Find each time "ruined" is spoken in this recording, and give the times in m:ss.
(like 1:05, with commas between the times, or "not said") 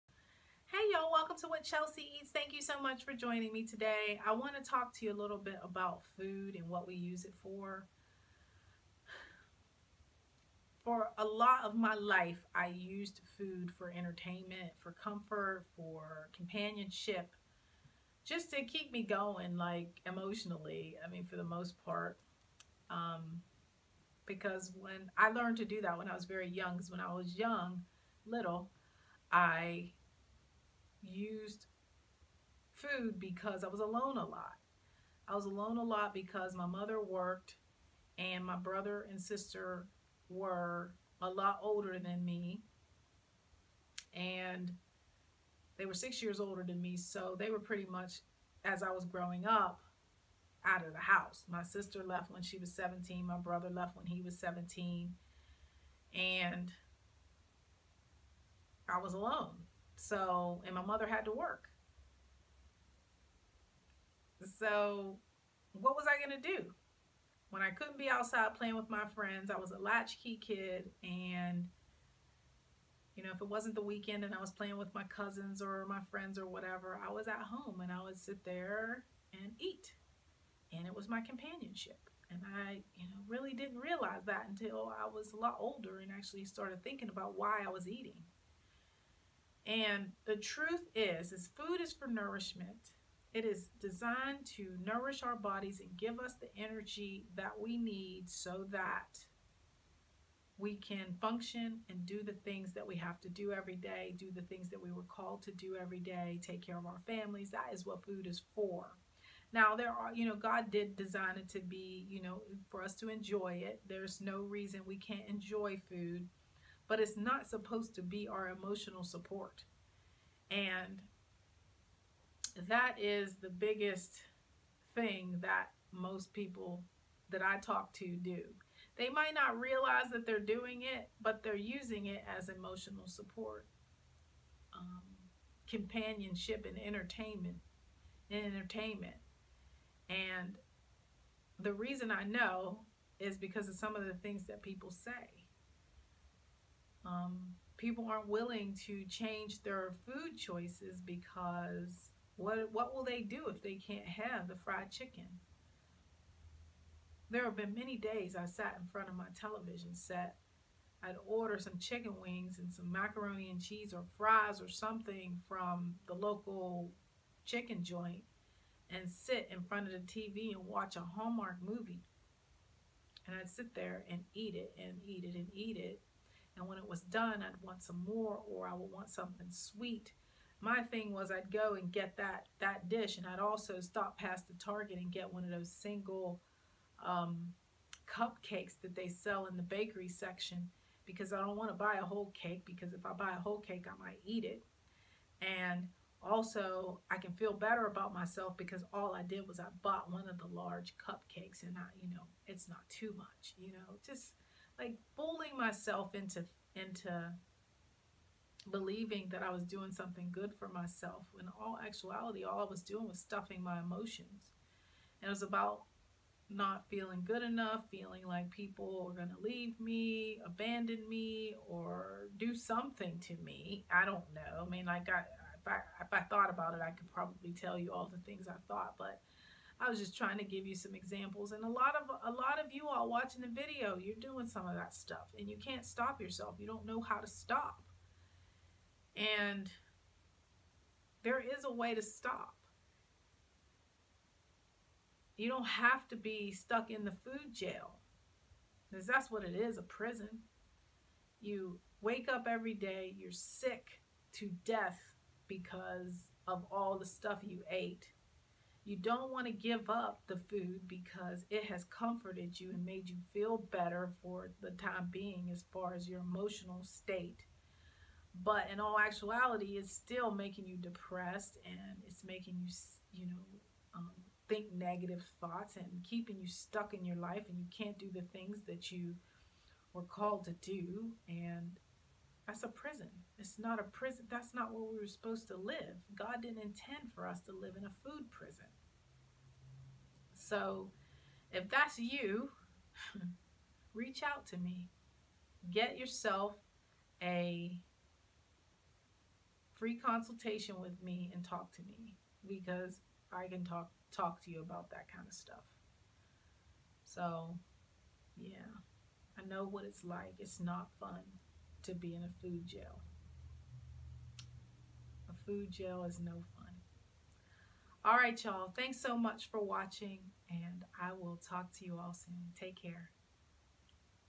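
not said.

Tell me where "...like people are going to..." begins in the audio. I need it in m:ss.
3:38.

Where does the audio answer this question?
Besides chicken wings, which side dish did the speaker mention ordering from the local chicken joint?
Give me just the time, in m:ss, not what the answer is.
2:42.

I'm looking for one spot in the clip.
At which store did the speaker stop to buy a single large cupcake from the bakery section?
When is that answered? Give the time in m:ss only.
3:04.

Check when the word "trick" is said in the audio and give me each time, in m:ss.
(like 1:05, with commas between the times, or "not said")
not said.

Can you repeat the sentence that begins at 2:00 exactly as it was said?
And that is the biggest thing that most people that I talk to do.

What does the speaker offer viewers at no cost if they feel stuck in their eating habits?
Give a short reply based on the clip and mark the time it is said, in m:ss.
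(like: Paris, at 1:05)
free consultation, at 4:59.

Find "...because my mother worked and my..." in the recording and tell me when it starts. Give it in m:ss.
0:36.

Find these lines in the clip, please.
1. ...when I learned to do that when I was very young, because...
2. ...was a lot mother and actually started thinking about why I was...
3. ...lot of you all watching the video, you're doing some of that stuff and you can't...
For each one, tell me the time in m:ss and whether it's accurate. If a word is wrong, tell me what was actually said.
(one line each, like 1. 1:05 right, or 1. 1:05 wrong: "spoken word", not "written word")
1. 0:24 right
2. 1:25 wrong: "older", not "mother"
3. 3:52 right.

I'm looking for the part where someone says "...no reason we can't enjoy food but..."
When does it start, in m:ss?
1:54.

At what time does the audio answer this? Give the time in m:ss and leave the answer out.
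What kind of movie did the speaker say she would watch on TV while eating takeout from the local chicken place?
2:50.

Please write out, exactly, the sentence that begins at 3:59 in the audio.
And there is a way to stop.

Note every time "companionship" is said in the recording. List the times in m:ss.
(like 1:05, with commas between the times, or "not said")
0:16, 1:21, 2:15.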